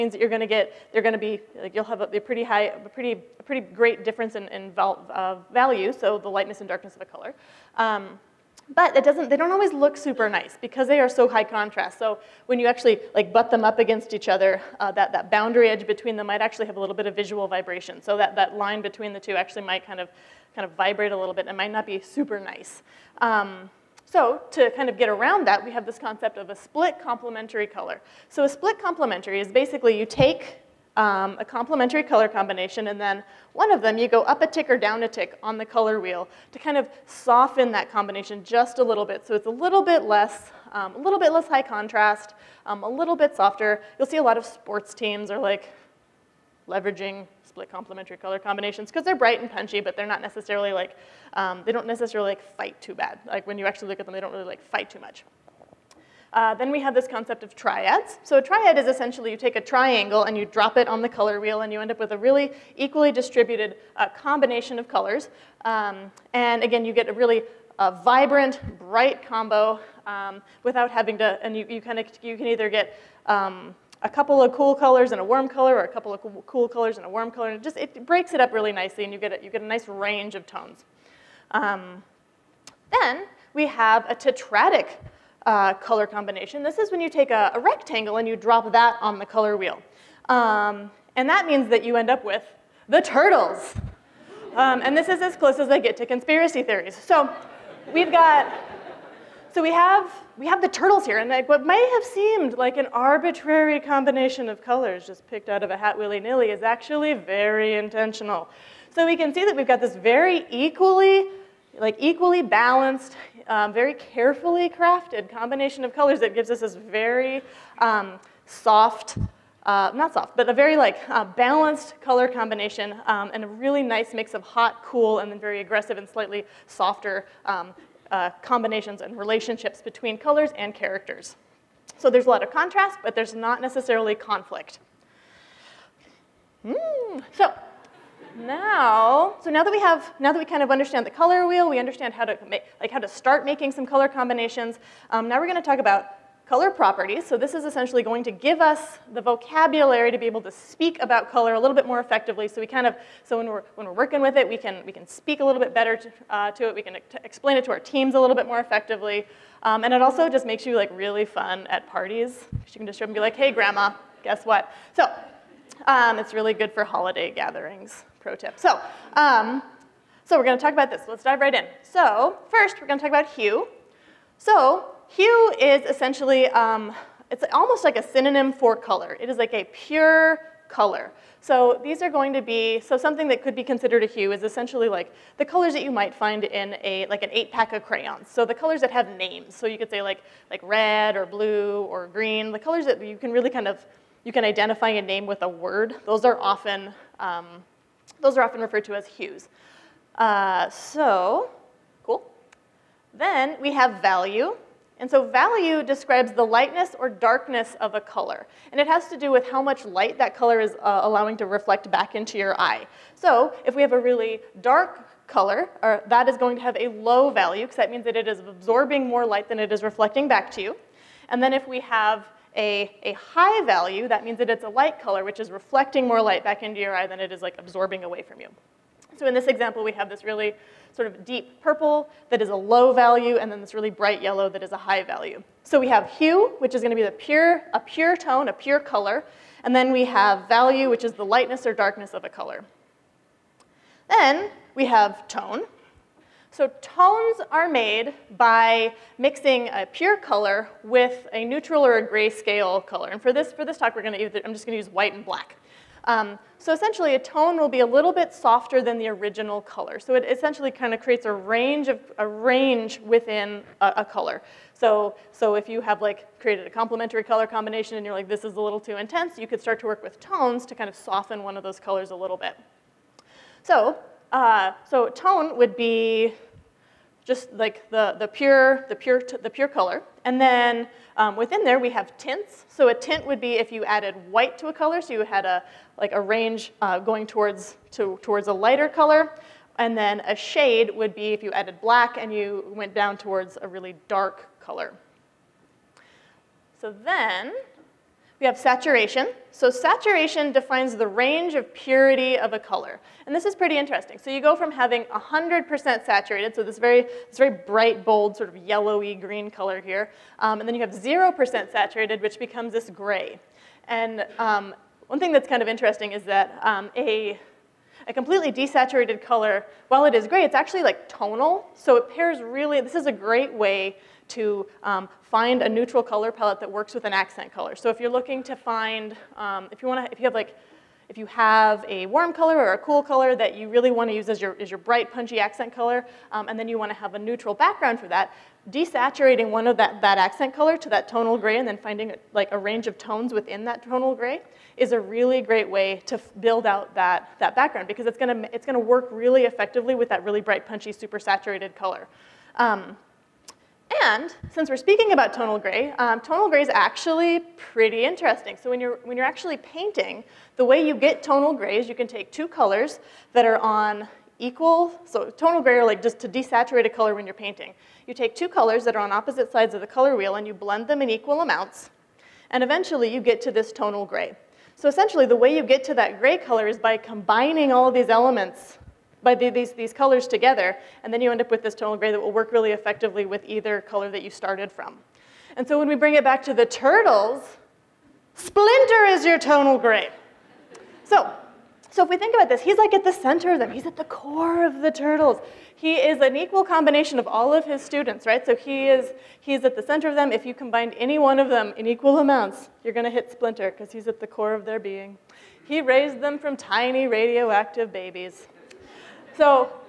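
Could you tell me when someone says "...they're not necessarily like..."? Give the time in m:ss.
0:49.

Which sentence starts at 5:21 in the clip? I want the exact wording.
So it pairs really, this is a great way to um, find a neutral color palette that works with an accent color.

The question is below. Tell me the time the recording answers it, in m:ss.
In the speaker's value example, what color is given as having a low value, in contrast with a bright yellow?
3:51.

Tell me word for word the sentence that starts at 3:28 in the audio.
And it has to do with how much light that color is uh, allowing to reflect back into your eye.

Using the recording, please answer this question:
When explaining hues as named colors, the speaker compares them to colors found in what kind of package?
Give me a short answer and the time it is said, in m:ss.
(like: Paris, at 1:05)
eight pack of crayons, at 3:07.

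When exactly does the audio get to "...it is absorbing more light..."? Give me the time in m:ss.
3:38.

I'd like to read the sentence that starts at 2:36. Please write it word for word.
We can explain it to our teams a little bit more effectively.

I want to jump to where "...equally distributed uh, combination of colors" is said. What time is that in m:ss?
1:02.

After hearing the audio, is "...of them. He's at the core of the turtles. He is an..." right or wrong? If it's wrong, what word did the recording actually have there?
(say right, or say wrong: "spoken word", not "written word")
right.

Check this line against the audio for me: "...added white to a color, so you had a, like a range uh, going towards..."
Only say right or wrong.
right.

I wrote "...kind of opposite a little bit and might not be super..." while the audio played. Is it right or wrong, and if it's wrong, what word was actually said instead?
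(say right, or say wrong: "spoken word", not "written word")
wrong: "vibrate", not "opposite".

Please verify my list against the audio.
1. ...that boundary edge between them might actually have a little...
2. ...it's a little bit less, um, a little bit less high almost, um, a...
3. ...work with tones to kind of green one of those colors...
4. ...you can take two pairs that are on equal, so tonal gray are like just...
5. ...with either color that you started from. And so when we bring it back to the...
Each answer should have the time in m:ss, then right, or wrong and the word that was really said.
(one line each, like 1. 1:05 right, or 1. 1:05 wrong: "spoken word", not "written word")
1. 0:15 right
2. 0:39 wrong: "contrast", not "almost"
3. 4:29 wrong: "soften", not "green"
4. 6:01 wrong: "colors", not "pairs"
5. 6:23 right.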